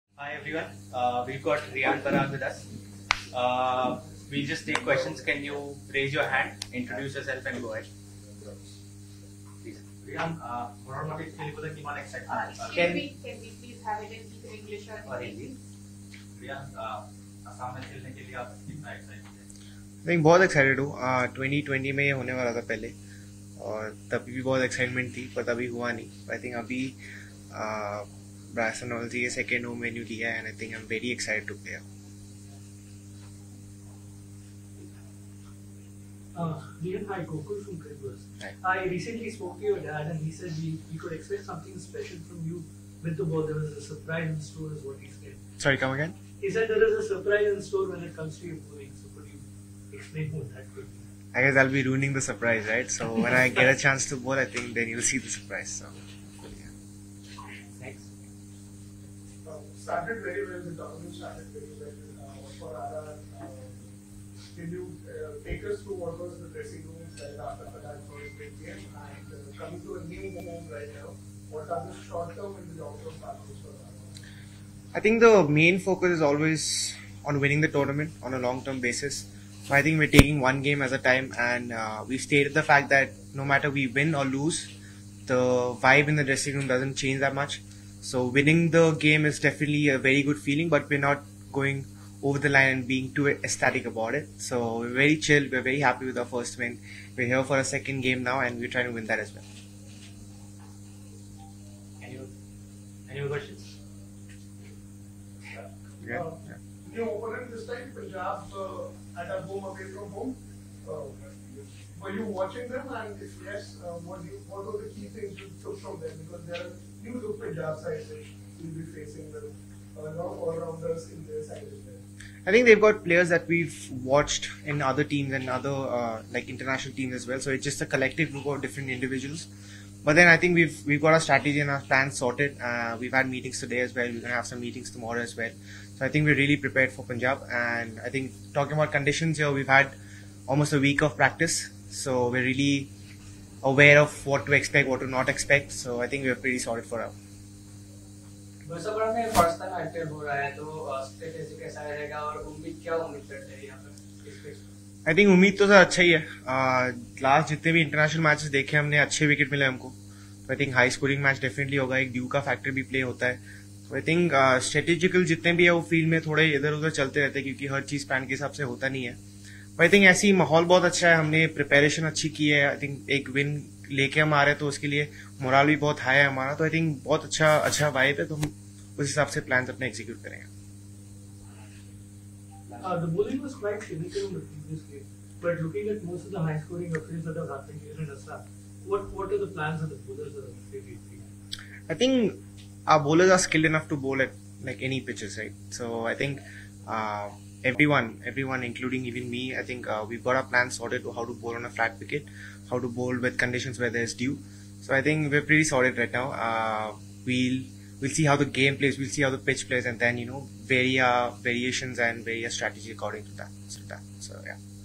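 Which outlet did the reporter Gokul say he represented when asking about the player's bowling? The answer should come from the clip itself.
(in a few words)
Credverse.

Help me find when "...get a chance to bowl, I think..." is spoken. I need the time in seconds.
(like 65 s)
53 s.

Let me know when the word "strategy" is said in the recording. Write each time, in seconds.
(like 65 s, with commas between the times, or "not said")
131 s, 212 s.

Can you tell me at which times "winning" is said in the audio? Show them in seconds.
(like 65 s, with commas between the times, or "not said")
77 s, 88 s.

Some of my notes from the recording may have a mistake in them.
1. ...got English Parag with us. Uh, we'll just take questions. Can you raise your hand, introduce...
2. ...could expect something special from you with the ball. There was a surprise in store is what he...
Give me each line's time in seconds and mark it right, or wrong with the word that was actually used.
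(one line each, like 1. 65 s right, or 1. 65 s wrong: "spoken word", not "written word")
1. 1 s wrong: "Riyan", not "English"
2. 41 s right.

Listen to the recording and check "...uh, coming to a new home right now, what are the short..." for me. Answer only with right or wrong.
right.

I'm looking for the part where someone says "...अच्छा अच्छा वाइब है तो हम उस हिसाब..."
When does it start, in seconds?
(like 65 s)
177 s.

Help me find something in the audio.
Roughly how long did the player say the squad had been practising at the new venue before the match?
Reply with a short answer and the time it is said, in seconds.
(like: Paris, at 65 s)
almost a week, at 140 s.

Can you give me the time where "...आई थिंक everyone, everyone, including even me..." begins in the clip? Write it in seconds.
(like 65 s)
196 s.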